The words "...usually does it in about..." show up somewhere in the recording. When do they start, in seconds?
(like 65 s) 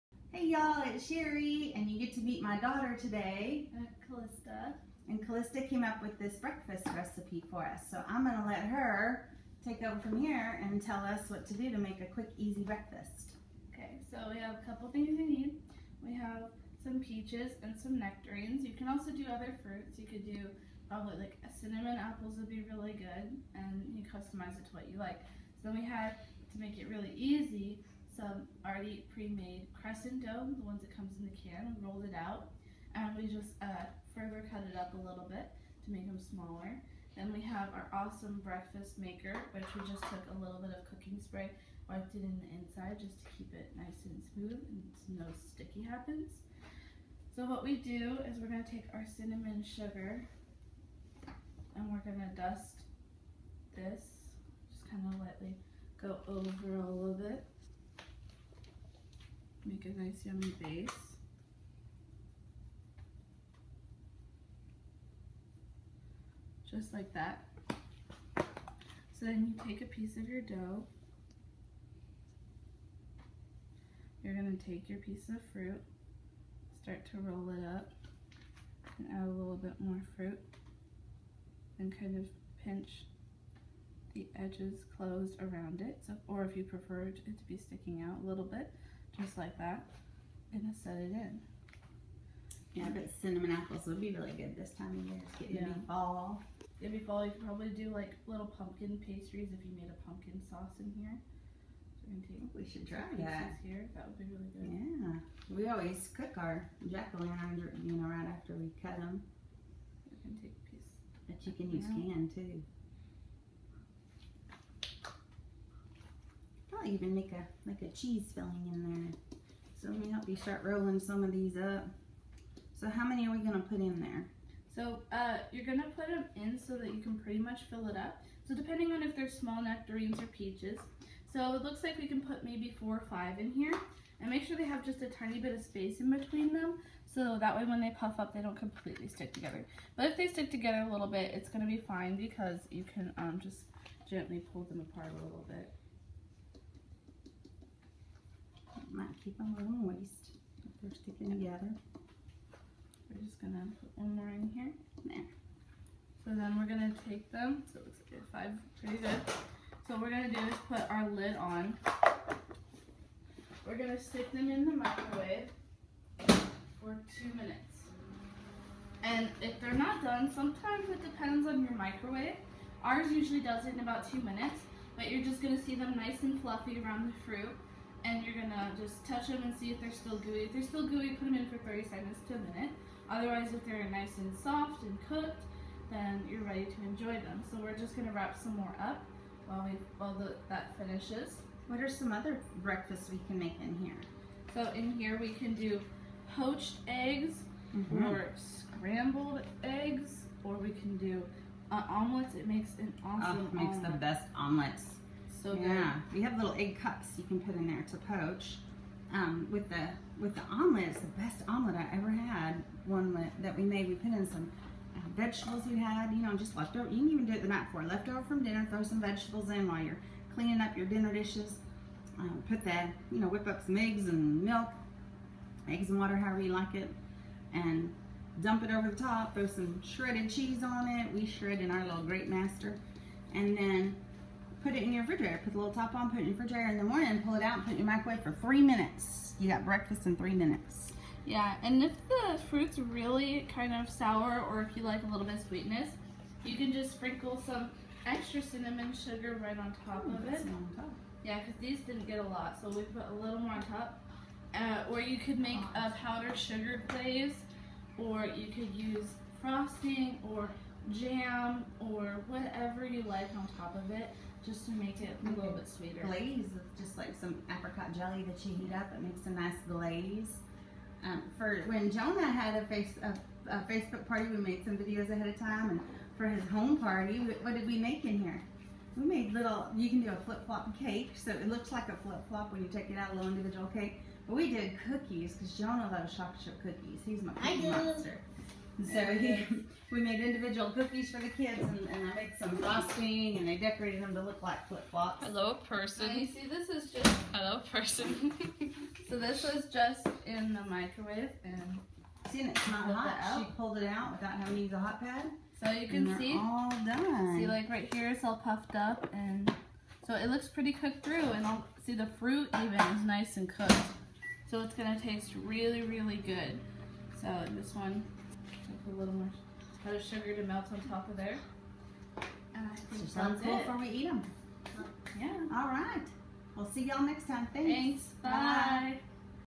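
173 s.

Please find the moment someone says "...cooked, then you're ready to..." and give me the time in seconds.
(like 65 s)
185 s.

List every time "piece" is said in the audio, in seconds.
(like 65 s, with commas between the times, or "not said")
69 s, 74 s, 110 s.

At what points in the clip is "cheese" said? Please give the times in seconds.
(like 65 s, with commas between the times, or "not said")
117 s, 230 s.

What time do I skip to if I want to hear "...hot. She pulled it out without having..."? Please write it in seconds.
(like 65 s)
302 s.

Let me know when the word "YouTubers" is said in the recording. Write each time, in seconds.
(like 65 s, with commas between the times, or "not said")
not said.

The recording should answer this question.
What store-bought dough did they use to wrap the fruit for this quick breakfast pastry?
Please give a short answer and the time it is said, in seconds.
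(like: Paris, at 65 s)
crescent dough, at 29 s.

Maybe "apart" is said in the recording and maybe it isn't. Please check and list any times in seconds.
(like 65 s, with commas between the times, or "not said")
144 s.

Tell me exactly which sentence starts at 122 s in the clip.
So how many are we gonna put in there?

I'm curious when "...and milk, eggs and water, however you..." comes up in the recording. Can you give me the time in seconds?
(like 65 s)
224 s.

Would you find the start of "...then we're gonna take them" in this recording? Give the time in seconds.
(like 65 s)
156 s.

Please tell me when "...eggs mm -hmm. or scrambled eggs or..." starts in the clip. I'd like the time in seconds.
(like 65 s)
196 s.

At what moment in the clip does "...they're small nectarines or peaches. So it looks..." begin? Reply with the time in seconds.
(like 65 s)
129 s.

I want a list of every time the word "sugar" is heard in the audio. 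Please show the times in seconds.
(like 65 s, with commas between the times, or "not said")
49 s, 248 s, 256 s, 320 s.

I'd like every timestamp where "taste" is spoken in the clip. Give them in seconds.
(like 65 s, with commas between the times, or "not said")
314 s.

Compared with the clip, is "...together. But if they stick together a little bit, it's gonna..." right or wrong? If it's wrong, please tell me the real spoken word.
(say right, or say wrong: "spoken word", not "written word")
right.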